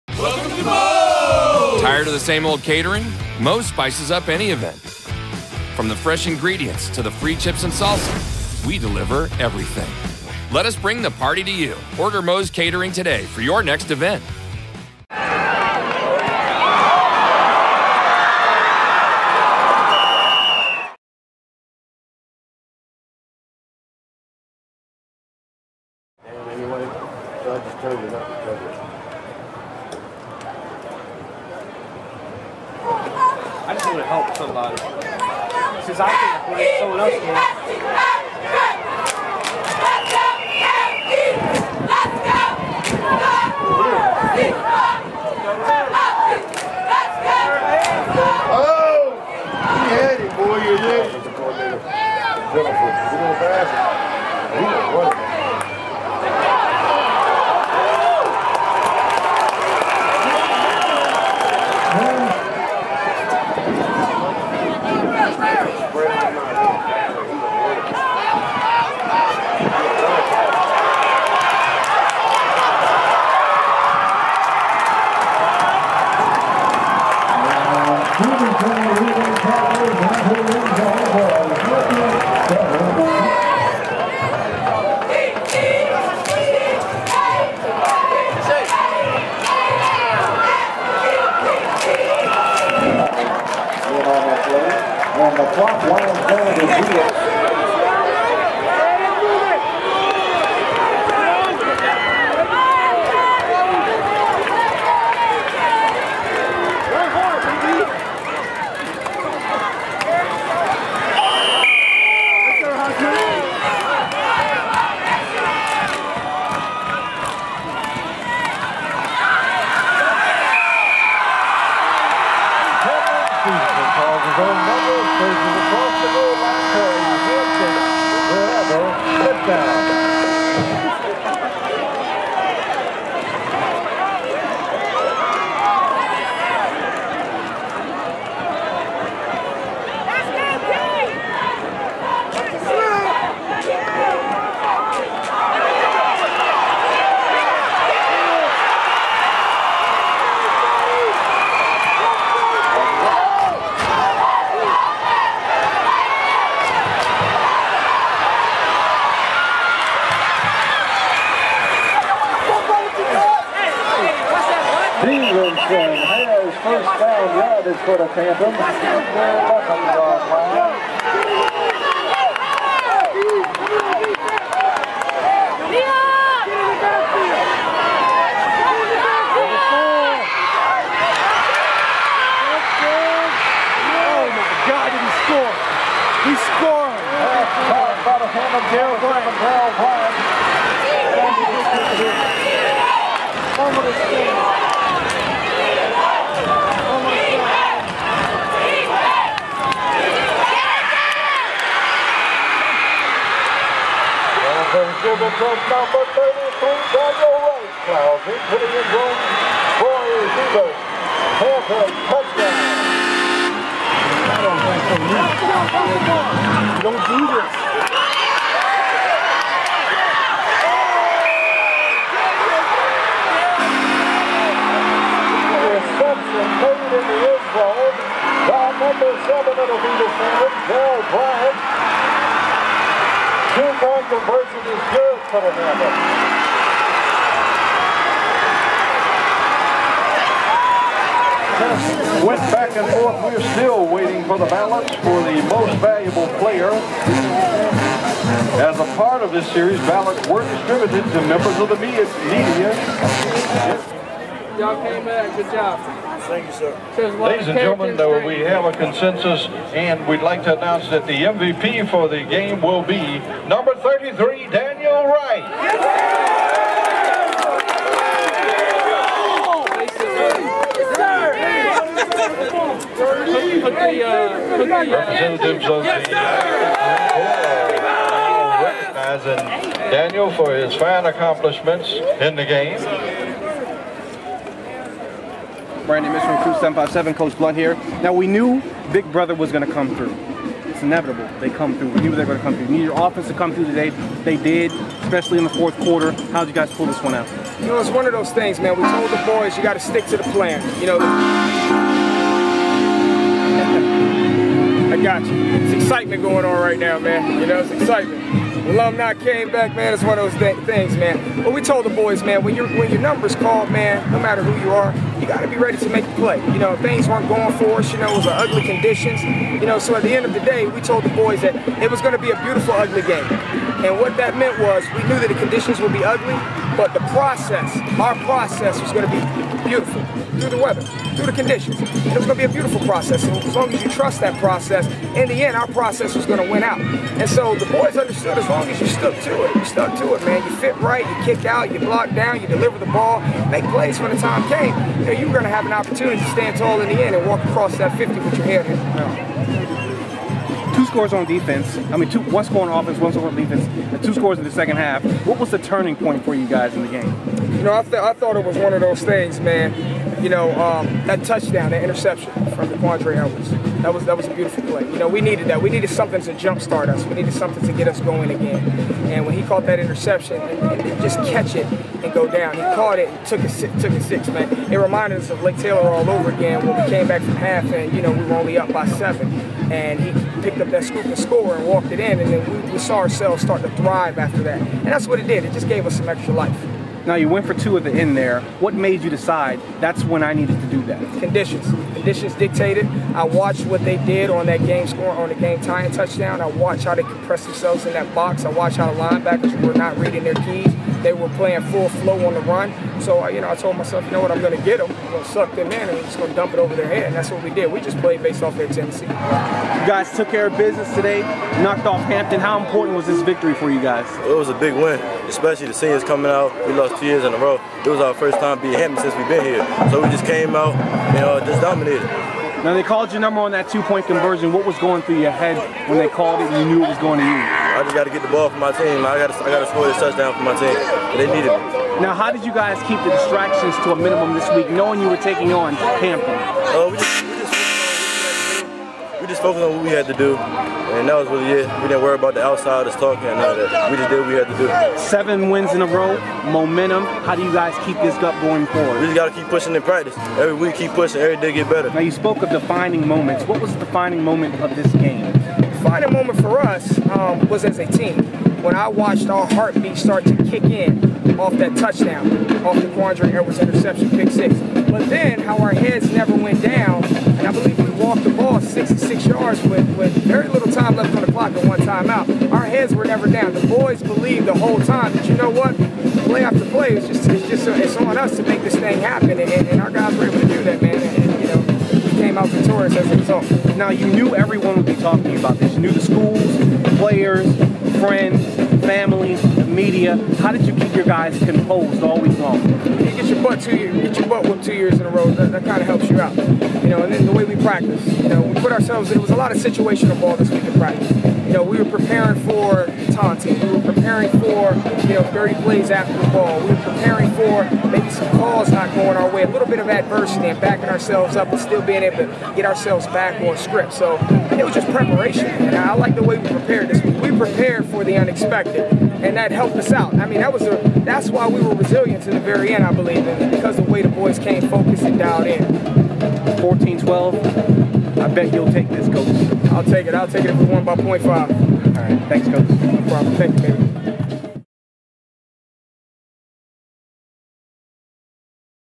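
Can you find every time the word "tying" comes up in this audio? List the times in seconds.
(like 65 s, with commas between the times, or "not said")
395 s.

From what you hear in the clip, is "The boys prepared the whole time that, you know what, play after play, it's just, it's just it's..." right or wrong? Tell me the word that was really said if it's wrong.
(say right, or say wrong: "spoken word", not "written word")
wrong: "believed", not "prepared".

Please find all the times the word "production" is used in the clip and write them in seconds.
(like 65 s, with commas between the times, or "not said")
not said.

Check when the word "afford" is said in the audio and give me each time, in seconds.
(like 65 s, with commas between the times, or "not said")
36 s.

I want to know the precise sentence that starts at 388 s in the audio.
What made you decide that's when I needed to do that?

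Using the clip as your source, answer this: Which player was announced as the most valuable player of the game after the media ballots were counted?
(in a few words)
Daniel Wright.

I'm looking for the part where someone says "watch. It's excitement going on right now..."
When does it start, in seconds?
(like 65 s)
305 s.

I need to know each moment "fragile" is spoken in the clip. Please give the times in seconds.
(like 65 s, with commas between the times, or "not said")
not said.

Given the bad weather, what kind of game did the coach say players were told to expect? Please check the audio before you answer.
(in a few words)
a beautiful, ugly game.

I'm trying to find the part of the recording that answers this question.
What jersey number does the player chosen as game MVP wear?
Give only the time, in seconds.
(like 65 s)
263 s.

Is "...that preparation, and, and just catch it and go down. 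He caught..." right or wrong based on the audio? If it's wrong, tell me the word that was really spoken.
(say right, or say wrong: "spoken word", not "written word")
wrong: "interception", not "preparation".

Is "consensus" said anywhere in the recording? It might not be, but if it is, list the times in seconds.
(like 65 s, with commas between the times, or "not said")
258 s.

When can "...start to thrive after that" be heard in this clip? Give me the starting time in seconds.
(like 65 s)
383 s.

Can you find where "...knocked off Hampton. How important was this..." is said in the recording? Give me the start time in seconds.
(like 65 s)
411 s.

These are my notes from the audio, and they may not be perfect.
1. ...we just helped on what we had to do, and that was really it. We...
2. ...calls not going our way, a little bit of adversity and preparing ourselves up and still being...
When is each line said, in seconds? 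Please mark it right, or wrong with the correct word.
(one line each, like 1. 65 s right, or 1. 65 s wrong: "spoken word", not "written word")
1. 439 s wrong: "focused", not "helped"
2. 508 s wrong: "backing", not "preparing".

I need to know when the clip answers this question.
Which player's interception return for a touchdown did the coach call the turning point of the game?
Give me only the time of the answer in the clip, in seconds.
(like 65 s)
362 s.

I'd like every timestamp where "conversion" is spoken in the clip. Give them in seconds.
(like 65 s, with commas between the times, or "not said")
234 s, 424 s.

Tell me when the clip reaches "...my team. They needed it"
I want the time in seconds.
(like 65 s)
430 s.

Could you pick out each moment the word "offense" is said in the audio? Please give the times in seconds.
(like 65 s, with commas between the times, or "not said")
293 s, 352 s.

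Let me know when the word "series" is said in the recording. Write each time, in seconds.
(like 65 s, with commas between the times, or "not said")
249 s.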